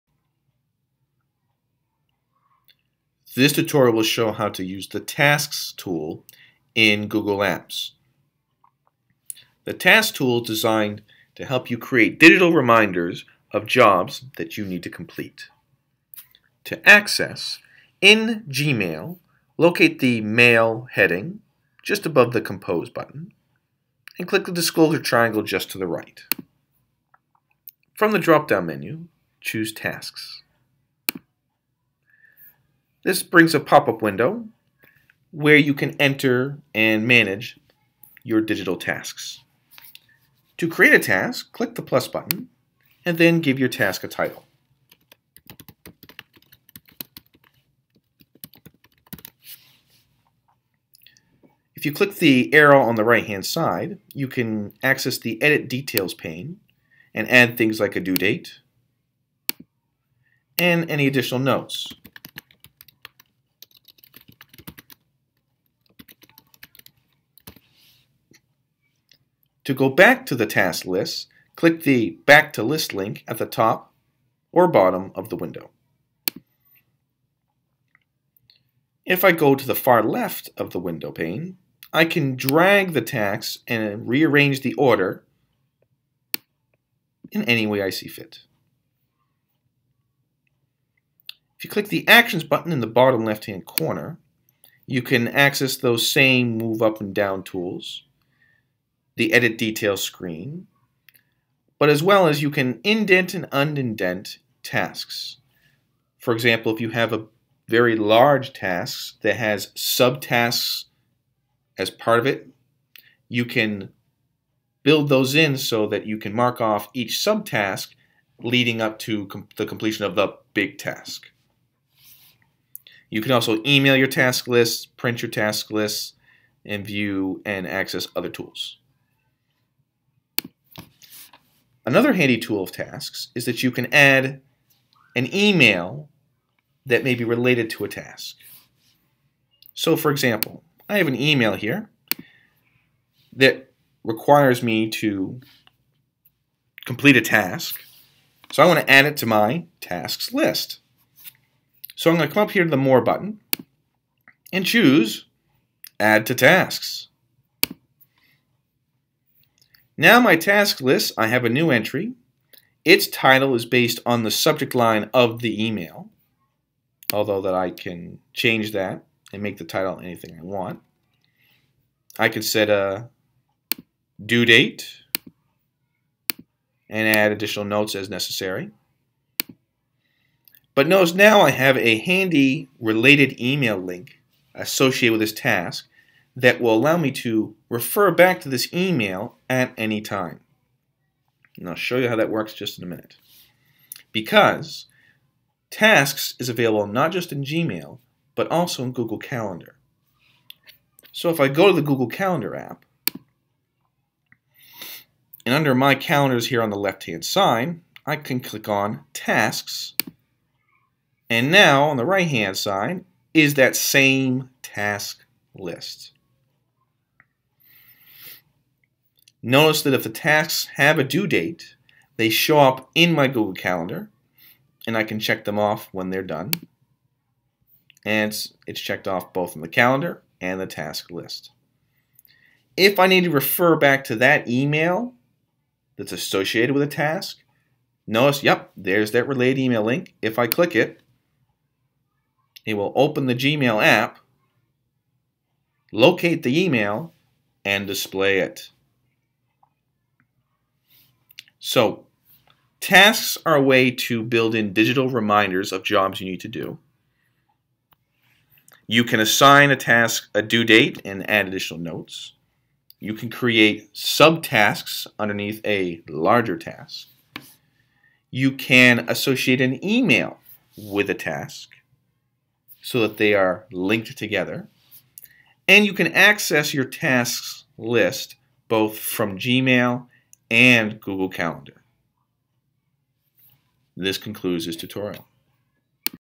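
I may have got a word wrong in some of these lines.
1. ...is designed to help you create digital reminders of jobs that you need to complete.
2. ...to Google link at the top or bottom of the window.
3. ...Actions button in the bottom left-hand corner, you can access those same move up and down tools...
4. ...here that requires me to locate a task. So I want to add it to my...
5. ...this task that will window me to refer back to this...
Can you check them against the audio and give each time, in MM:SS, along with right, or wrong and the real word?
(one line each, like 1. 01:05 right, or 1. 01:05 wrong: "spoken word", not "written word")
1. 00:10 right
2. 01:12 wrong: "List", not "Google"
3. 01:32 right
4. 02:21 wrong: "complete", not "locate"
5. 03:05 wrong: "allow", not "window".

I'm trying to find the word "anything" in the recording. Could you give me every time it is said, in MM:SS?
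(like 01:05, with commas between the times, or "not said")
02:49.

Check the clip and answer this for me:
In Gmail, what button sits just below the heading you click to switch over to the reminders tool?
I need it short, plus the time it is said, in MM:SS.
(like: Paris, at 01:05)
Compose, at 00:22.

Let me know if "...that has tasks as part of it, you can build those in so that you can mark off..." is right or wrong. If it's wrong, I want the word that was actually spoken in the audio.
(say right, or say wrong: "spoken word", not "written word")
wrong: "subtasks", not "tasks".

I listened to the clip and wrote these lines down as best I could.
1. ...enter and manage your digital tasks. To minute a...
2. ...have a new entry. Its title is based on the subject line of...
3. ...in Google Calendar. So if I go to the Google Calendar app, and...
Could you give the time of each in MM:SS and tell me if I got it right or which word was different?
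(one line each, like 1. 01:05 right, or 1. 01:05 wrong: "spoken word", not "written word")
1. 00:35 wrong: "create", not "minute"
2. 02:41 right
3. 03:18 right.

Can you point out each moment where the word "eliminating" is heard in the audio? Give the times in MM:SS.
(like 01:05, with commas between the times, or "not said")
not said.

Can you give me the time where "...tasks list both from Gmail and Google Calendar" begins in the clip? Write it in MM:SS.
04:36.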